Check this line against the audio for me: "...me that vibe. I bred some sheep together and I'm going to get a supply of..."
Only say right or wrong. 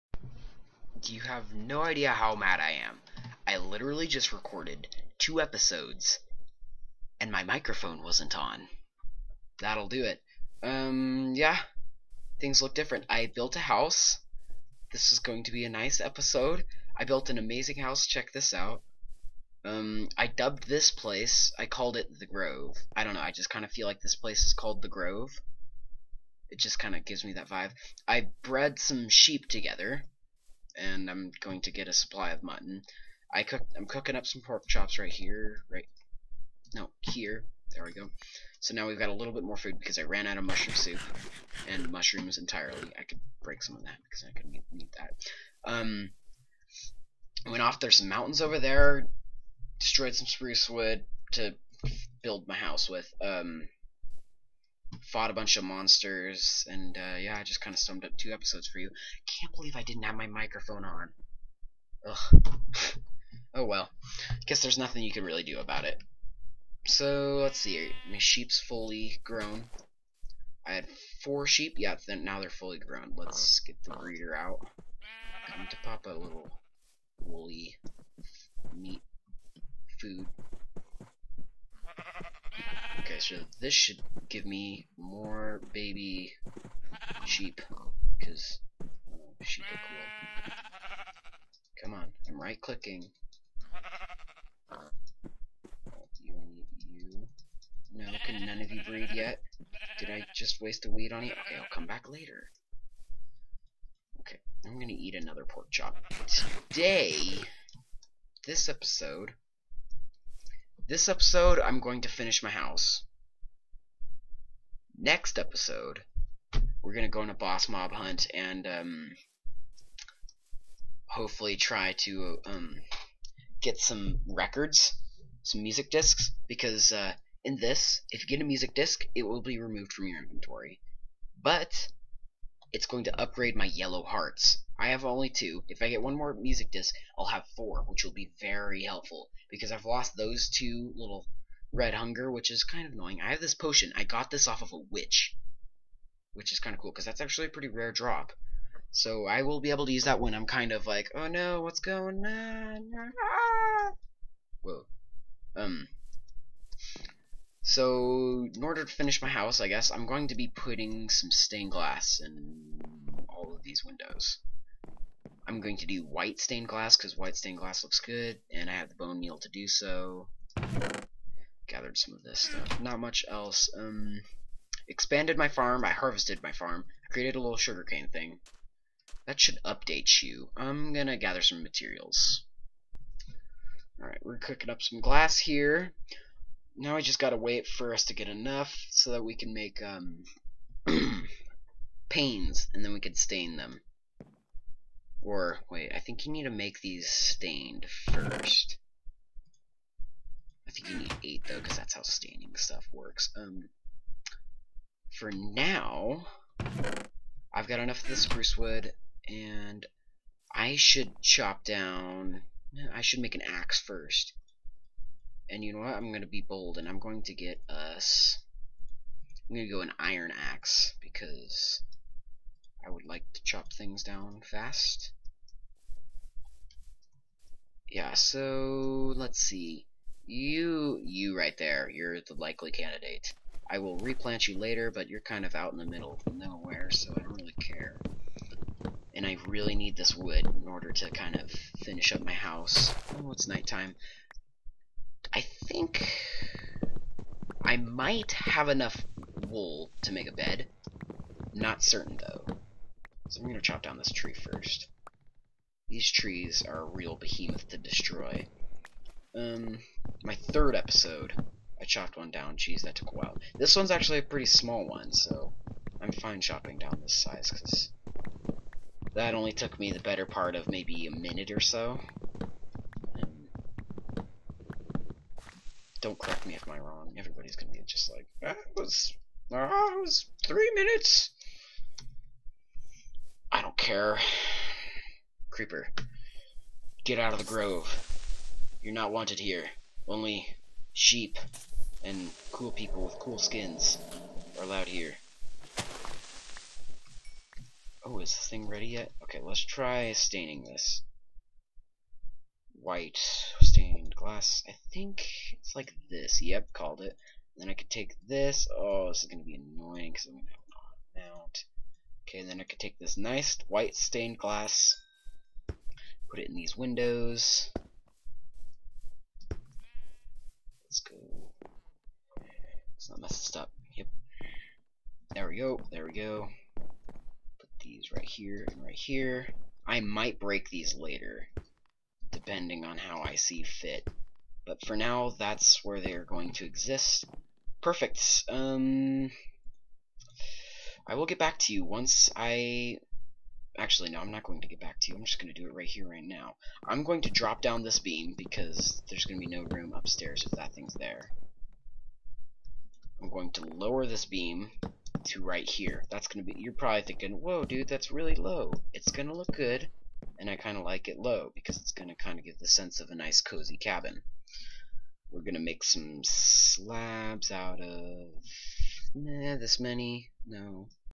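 right.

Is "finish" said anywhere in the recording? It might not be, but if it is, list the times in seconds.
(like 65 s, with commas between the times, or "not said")
112 s, 158 s, 241 s.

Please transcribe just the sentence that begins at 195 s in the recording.
Or, wait, I think you need to make these stained first.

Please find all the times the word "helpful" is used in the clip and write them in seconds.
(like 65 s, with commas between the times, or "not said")
138 s.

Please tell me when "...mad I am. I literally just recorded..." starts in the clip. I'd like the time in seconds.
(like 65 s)
2 s.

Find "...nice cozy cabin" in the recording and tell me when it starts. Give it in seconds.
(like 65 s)
363 s.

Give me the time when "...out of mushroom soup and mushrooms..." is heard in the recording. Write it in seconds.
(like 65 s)
40 s.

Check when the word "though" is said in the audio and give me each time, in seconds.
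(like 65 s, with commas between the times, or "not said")
201 s, 252 s.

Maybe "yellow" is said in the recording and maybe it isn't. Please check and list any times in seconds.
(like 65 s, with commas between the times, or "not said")
133 s.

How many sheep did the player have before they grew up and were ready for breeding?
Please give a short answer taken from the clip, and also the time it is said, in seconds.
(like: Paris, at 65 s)
4, at 71 s.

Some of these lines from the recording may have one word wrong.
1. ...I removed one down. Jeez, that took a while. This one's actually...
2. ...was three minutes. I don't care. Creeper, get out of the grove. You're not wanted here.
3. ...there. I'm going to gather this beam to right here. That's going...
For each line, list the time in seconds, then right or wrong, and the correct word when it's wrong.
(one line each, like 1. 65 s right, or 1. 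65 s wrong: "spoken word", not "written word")
1. 261 s wrong: "chopped", not "removed"
2. 280 s right
3. 350 s wrong: "lower", not "gather".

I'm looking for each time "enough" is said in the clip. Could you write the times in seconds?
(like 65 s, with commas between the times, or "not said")
188 s, 207 s, 248 s.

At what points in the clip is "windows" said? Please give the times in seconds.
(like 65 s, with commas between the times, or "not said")
163 s, 316 s.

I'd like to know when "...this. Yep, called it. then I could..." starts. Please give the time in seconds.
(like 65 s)
306 s.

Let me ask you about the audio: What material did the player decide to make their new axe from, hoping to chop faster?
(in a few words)
iron.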